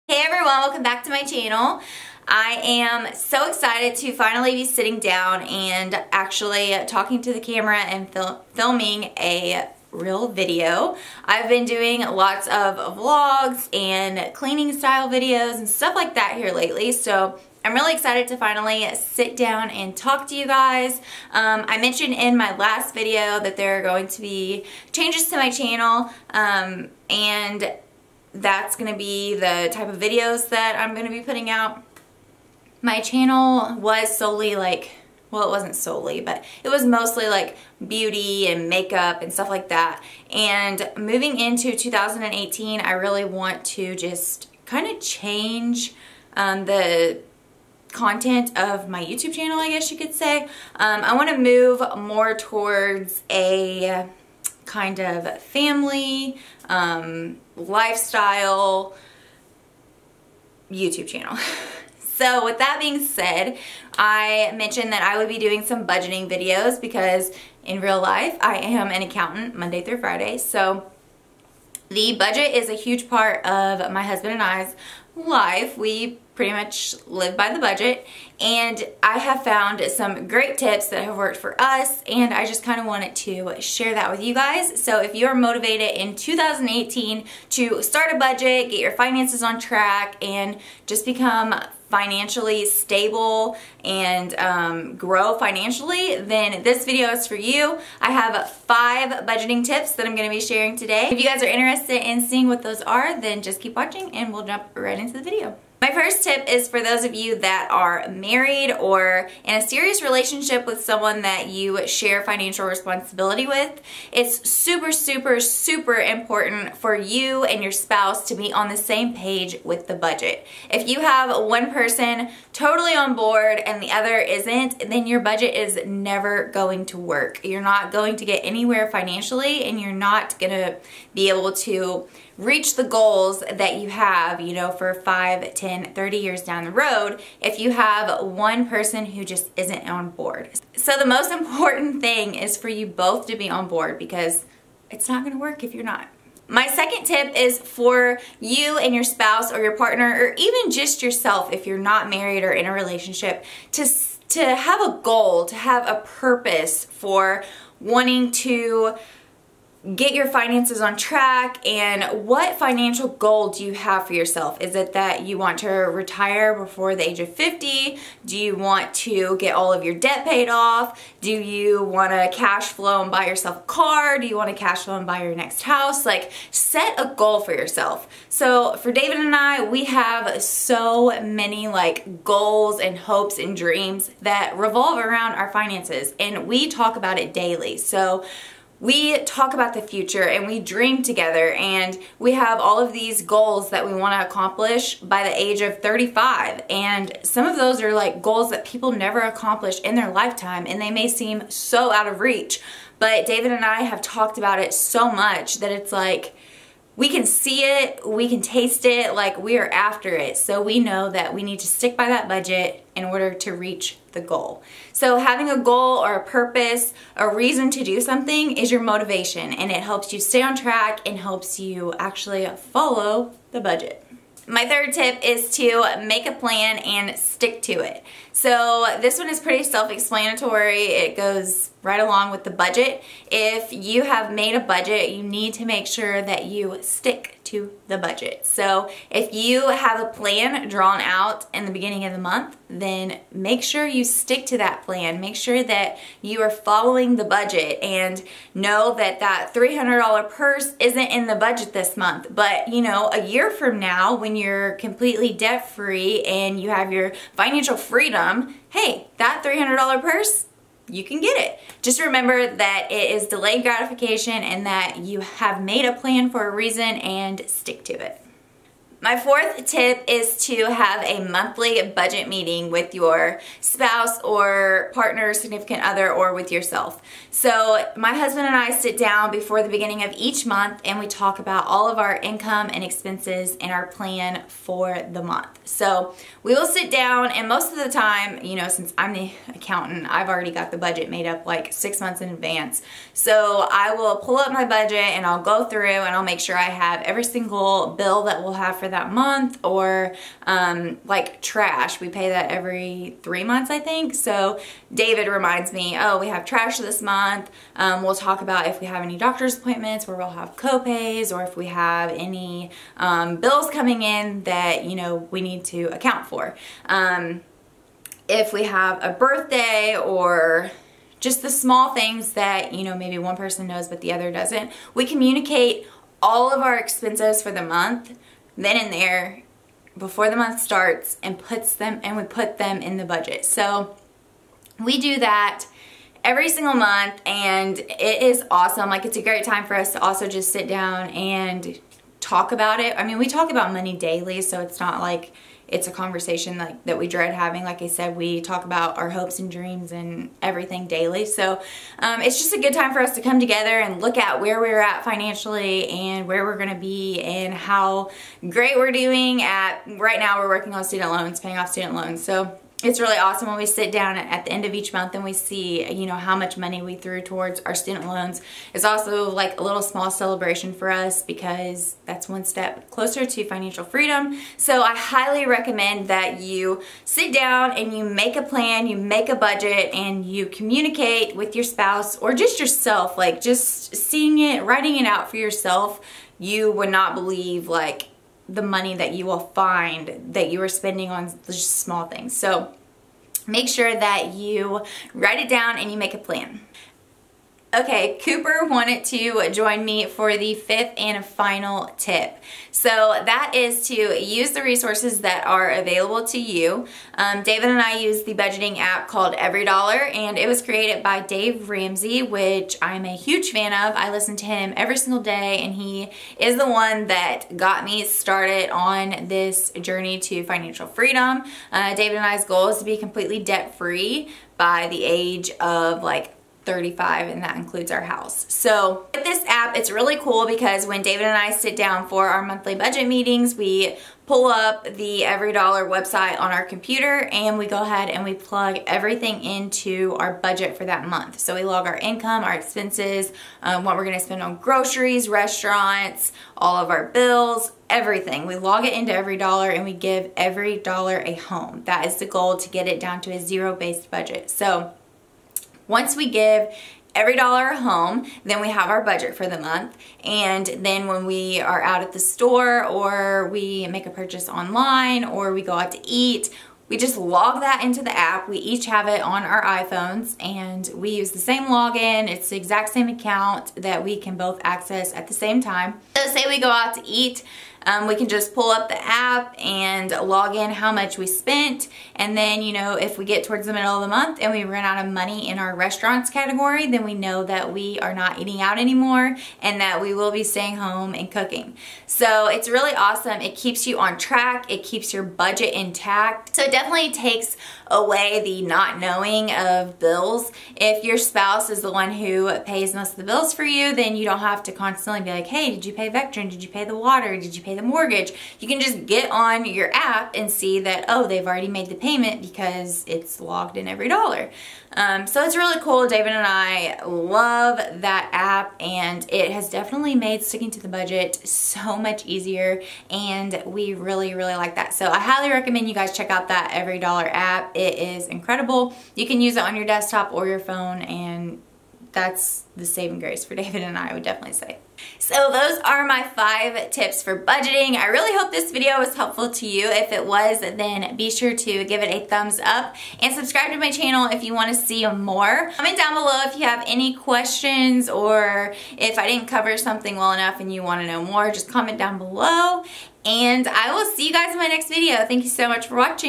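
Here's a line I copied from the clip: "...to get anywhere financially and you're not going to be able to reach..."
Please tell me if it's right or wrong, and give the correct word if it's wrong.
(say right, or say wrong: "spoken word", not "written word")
right.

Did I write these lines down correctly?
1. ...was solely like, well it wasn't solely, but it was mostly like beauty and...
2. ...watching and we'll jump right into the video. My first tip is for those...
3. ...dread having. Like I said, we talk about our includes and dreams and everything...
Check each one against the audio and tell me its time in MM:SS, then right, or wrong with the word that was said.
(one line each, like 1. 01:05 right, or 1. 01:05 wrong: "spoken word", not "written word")
1. 00:33 right
2. 01:43 right
3. 05:47 wrong: "hopes", not "includes".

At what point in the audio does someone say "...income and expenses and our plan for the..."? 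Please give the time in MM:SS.
04:42.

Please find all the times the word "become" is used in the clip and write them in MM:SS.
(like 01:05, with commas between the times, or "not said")
01:31.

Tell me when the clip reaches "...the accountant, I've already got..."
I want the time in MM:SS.
04:49.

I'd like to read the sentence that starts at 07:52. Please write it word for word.
It's the exact same account that we can both access at the same time.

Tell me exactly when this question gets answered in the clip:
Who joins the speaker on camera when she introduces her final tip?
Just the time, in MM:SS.
06:38.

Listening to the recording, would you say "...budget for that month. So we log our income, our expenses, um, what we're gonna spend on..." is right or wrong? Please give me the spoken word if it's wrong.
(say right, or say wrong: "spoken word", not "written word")
right.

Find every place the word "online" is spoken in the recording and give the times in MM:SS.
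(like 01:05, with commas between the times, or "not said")
07:44.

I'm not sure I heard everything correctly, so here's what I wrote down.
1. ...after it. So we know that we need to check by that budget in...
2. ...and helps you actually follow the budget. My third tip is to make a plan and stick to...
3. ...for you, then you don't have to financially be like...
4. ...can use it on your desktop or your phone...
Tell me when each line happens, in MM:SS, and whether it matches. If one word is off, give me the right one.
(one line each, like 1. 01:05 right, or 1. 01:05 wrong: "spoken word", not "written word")
1. 03:29 wrong: "stick", not "check"
2. 03:41 right
3. 08:23 wrong: "constantly", not "financially"
4. 08:49 right.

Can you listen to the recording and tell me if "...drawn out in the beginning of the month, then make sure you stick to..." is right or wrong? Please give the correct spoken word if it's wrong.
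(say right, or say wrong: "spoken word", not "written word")
right.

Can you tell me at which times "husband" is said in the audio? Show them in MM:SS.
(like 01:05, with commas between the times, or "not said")
01:14, 04:38.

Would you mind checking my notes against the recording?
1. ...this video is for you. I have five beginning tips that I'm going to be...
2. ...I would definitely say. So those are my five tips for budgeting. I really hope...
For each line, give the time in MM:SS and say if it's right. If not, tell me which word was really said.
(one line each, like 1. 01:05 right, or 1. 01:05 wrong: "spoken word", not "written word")
1. 01:36 wrong: "budgeting", not "beginning"
2. 08:53 right.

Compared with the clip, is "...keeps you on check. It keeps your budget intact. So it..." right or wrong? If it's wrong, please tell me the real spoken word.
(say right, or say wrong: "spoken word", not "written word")
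wrong: "track", not "check".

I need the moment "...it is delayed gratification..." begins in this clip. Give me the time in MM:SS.
04:22.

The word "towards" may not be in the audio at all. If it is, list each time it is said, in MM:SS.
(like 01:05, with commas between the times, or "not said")
00:52, 06:07, 08:03.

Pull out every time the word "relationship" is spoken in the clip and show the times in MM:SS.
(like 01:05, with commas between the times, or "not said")
01:50, 02:32.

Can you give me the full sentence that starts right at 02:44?
Is it that you want to retire before the age of 50?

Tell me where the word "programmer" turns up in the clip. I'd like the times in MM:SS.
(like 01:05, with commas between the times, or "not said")
not said.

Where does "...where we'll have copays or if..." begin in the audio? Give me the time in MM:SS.
05:10.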